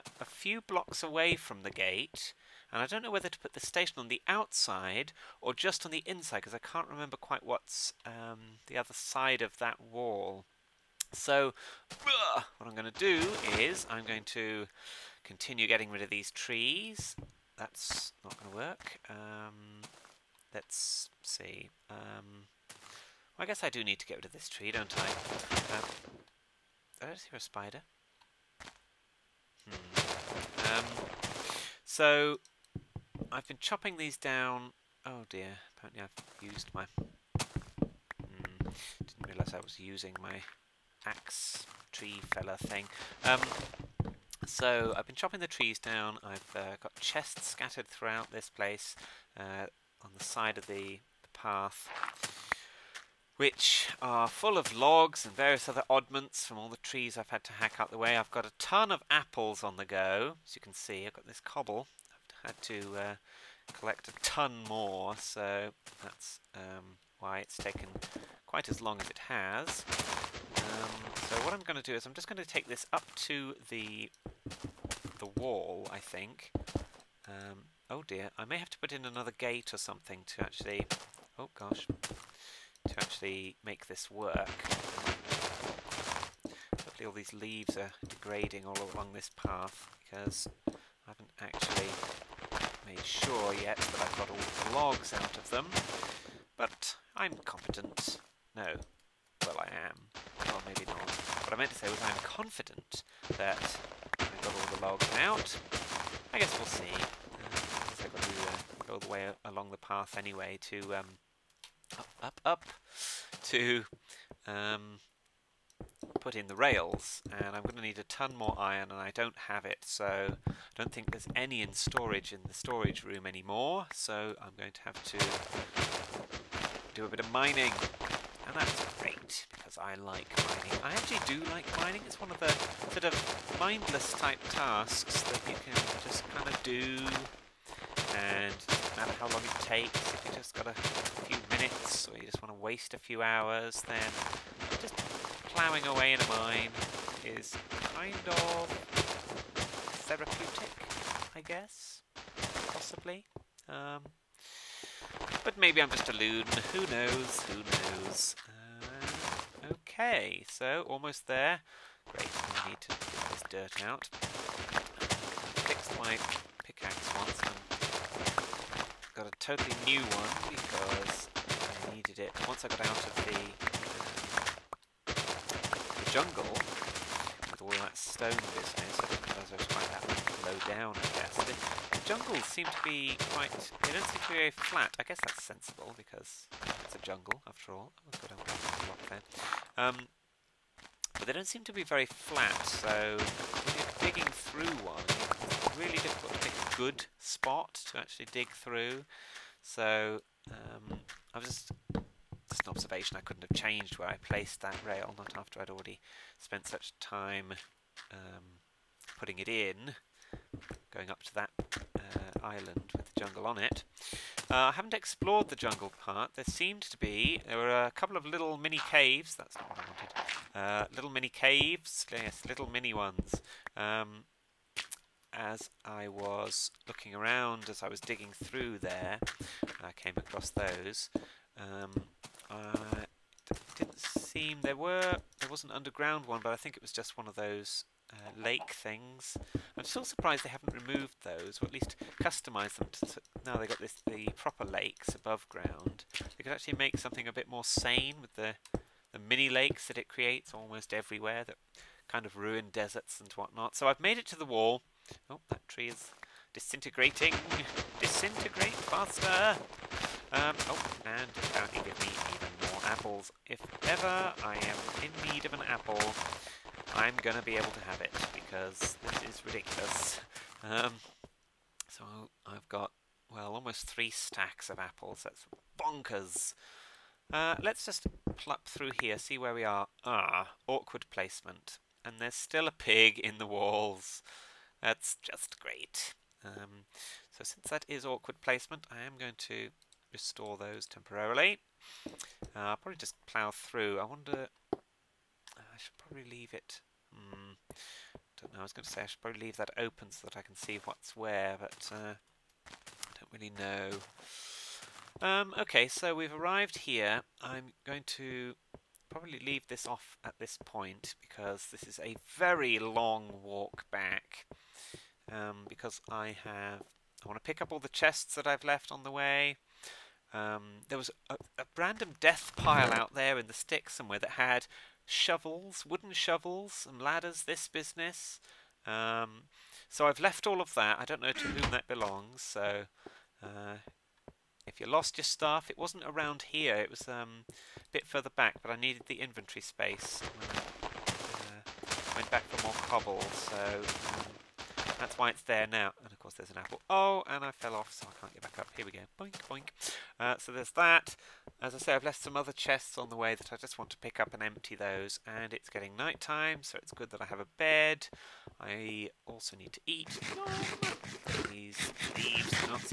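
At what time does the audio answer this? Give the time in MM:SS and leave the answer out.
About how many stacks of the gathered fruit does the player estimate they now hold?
04:33.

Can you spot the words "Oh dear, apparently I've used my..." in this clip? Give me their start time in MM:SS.
00:35.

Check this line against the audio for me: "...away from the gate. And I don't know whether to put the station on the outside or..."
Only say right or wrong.
right.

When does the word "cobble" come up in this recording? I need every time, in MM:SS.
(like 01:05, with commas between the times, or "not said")
01:01, 05:42.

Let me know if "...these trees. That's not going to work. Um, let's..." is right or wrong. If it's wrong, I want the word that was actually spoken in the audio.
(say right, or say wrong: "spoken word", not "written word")
right.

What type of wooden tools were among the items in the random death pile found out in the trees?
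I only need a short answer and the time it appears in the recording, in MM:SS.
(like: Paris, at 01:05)
wooden shovels, at 05:25.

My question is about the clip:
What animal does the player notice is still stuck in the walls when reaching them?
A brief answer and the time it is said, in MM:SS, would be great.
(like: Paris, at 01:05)
a pig, at 04:42.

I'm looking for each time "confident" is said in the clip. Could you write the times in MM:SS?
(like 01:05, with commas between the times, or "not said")
01:42.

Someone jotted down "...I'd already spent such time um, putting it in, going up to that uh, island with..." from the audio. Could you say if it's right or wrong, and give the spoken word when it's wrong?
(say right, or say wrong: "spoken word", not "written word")
right.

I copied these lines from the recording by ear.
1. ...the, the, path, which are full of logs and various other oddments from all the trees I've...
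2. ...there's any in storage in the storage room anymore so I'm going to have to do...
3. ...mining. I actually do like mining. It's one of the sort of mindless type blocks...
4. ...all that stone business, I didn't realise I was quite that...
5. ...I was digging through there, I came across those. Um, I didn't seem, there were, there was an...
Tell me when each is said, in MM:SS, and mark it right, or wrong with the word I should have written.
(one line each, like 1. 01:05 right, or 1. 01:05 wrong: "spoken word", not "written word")
1. 00:50 right
2. 02:01 right
3. 02:10 wrong: "tasks", not "blocks"
4. 02:57 right
5. 03:47 right.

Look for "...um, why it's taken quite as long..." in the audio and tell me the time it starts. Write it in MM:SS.
01:06.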